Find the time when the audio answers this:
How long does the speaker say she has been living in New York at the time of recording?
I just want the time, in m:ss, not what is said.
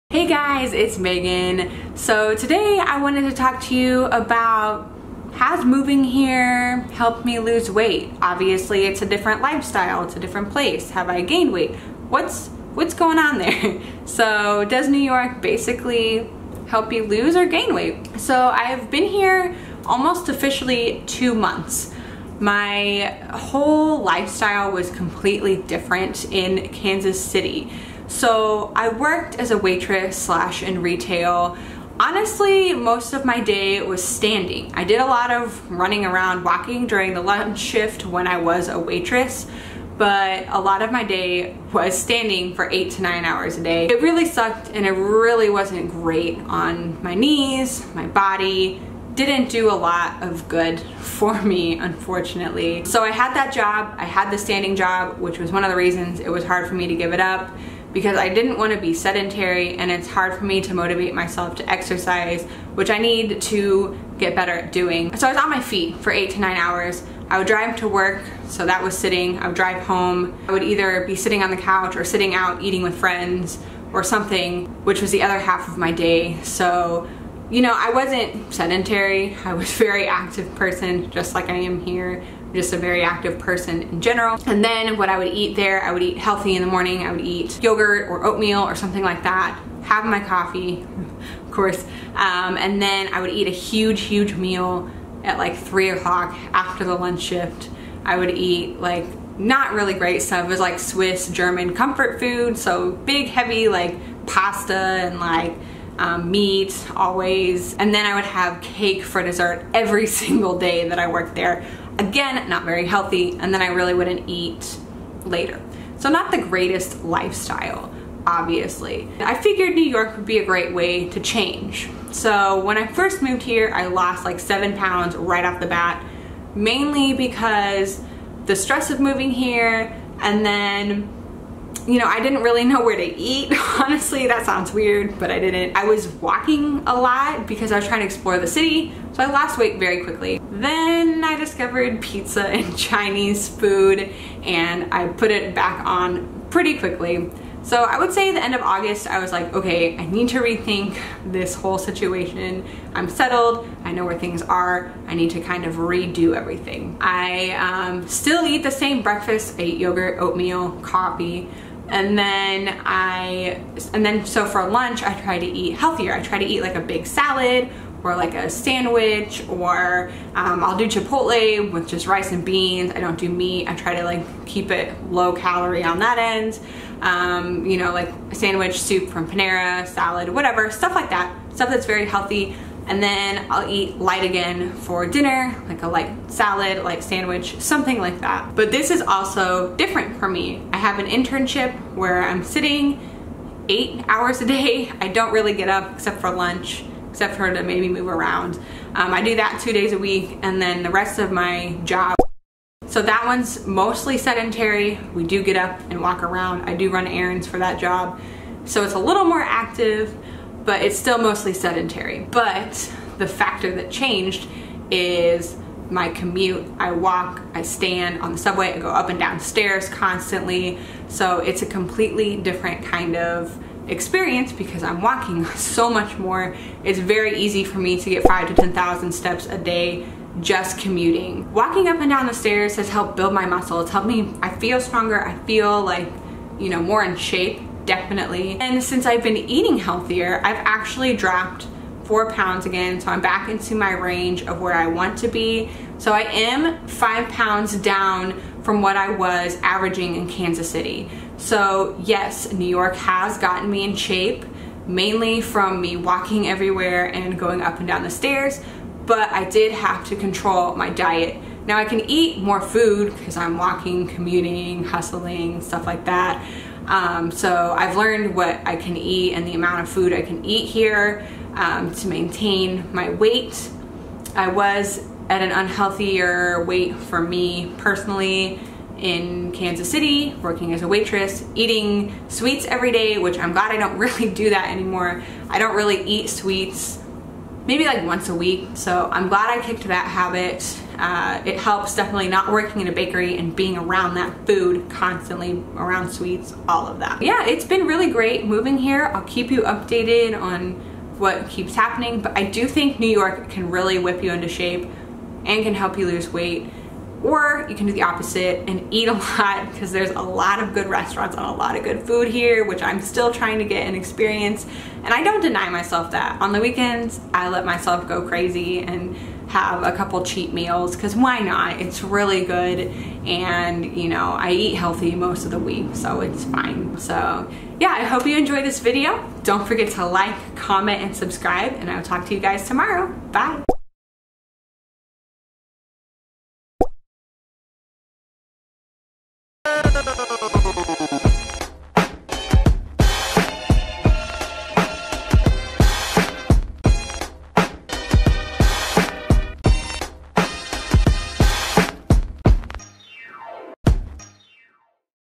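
0:21.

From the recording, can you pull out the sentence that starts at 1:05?
So I was on my feet for eight to nine hours.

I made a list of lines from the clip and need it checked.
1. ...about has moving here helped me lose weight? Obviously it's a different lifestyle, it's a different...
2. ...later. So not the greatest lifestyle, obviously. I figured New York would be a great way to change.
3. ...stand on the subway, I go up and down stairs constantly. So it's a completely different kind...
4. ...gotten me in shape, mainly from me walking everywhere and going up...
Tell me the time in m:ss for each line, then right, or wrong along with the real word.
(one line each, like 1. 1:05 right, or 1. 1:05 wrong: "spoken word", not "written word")
1. 0:04 right
2. 1:55 right
3. 3:37 right
4. 4:13 right.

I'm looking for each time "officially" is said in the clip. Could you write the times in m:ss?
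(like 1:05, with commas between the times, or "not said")
0:20.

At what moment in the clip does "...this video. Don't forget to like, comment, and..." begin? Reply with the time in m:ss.
5:28.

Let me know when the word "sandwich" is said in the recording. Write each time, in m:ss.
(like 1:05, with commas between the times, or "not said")
2:48, 2:58, 3:07.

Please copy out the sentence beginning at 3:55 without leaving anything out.
I feel like, you know, more in shape definitely.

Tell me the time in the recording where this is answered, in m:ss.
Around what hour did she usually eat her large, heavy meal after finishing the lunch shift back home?
1:35.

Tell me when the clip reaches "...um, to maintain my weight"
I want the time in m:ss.
4:31.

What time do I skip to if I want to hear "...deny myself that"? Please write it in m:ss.
5:15.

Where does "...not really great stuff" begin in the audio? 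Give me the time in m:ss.
1:39.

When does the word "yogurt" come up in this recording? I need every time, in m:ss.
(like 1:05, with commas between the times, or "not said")
1:27, 2:39.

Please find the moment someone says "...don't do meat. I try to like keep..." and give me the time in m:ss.
2:53.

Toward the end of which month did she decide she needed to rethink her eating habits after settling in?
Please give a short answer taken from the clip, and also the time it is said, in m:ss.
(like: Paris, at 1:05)
August, at 2:28.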